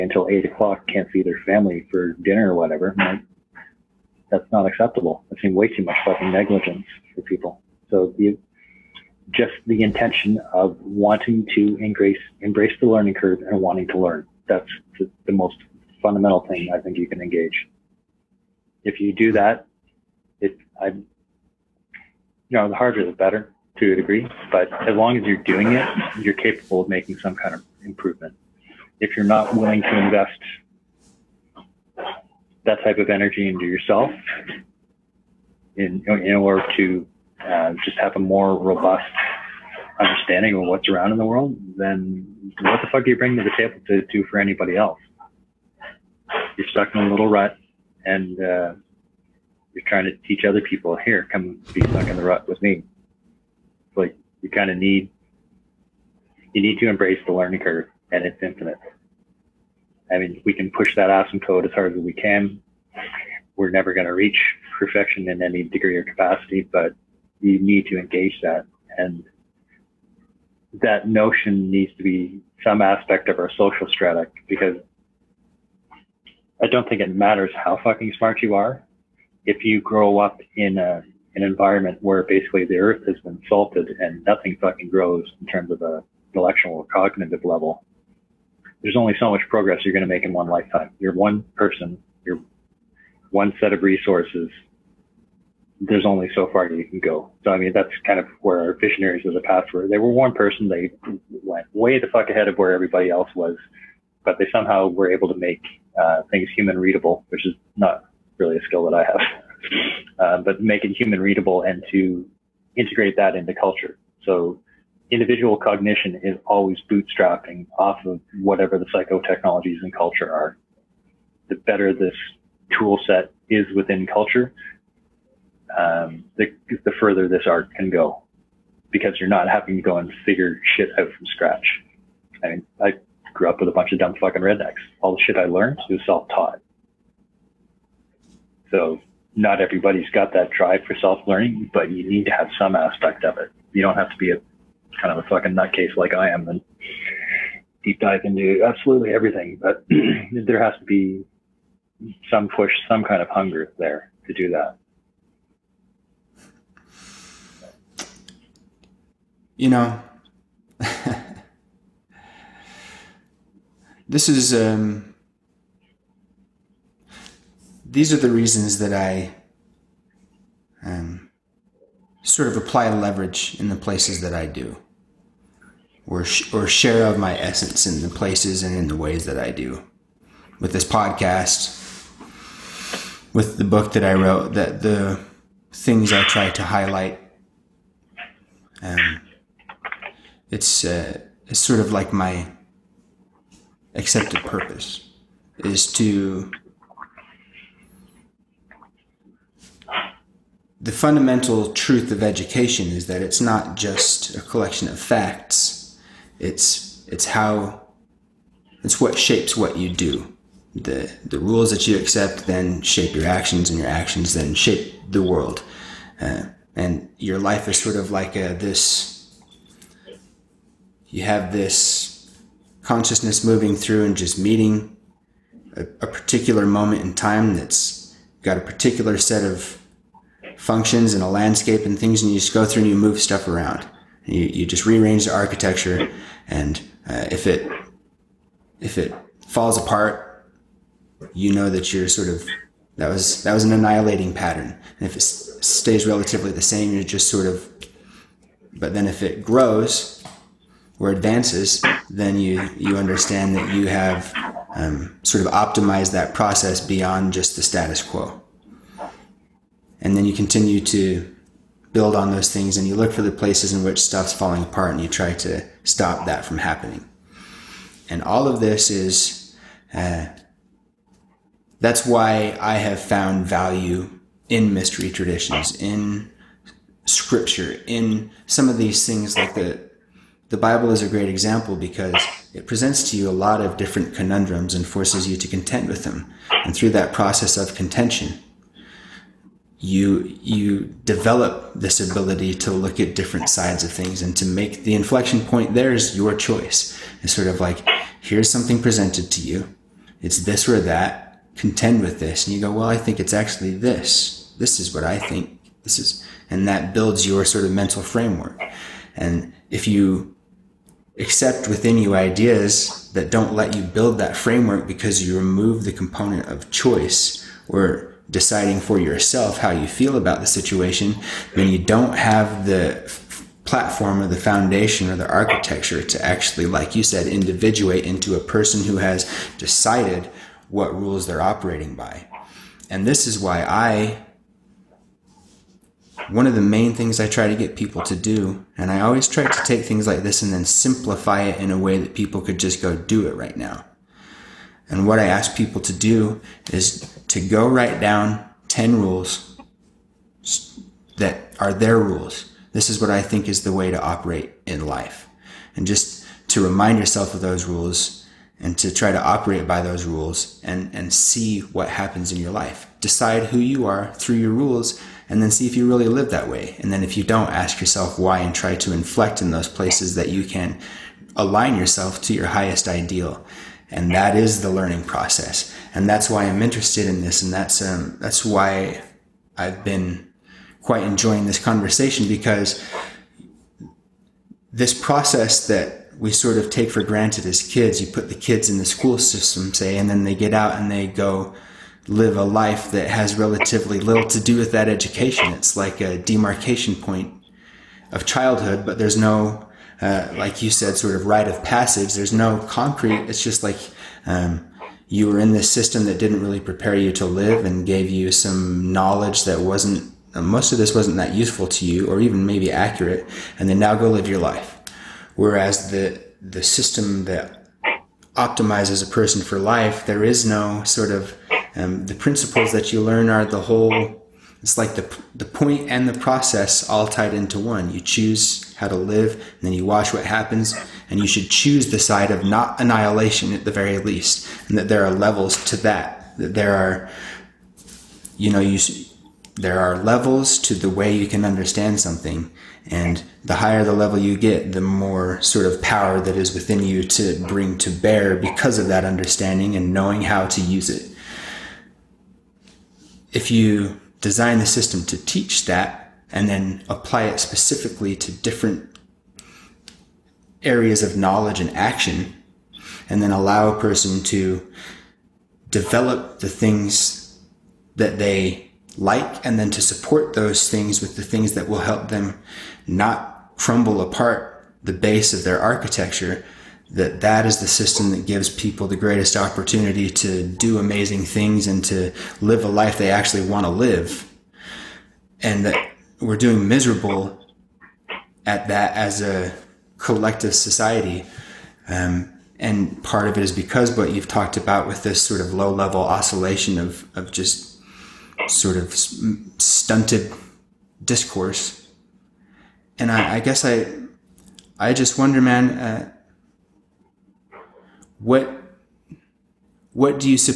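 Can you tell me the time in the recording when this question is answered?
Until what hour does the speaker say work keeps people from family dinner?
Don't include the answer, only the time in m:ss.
0:00.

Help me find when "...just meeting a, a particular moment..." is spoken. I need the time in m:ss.
3:44.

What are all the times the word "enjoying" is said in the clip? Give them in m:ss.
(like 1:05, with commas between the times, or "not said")
6:21.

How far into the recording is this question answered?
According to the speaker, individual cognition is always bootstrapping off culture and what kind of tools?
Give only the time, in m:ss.
1:58.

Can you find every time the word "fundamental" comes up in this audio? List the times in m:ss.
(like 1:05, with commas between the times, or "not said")
0:16, 3:20.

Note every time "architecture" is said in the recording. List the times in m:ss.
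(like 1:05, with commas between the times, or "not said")
3:55, 5:25, 7:55.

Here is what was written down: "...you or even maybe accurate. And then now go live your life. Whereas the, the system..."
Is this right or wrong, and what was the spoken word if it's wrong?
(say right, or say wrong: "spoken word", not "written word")
right.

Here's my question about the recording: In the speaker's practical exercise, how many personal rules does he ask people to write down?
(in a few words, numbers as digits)
10.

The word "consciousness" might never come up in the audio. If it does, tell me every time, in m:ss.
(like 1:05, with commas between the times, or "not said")
3:42.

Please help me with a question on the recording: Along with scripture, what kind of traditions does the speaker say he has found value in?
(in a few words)
mystery traditions.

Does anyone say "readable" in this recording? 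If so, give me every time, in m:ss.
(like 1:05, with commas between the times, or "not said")
1:46, 1:51.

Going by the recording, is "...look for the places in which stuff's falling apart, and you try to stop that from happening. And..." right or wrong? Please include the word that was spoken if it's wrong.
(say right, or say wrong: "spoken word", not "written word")
right.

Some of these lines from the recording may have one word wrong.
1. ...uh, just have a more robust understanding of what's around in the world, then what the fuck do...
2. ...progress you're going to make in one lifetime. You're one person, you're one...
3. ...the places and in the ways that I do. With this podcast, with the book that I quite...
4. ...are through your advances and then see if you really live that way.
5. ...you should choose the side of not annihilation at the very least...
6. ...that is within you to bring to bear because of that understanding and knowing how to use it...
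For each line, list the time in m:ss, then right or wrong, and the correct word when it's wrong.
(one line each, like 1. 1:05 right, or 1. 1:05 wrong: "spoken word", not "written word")
1. 0:37 right
2. 1:29 right
3. 2:58 wrong: "wrote", not "quite"
4. 6:03 wrong: "rules", not "advances"
5. 7:11 right
6. 7:26 right.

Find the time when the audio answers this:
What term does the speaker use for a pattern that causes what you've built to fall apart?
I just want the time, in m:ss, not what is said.
4:03.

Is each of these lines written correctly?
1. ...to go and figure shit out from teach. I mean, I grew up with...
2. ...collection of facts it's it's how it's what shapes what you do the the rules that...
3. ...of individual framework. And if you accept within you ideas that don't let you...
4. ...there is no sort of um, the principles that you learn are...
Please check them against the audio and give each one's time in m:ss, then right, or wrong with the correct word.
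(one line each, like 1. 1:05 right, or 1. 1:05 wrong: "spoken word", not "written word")
1. 2:09 wrong: "scratch", not "teach"
2. 3:24 right
3. 5:07 wrong: "mental", not "individual"
4. 7:00 right.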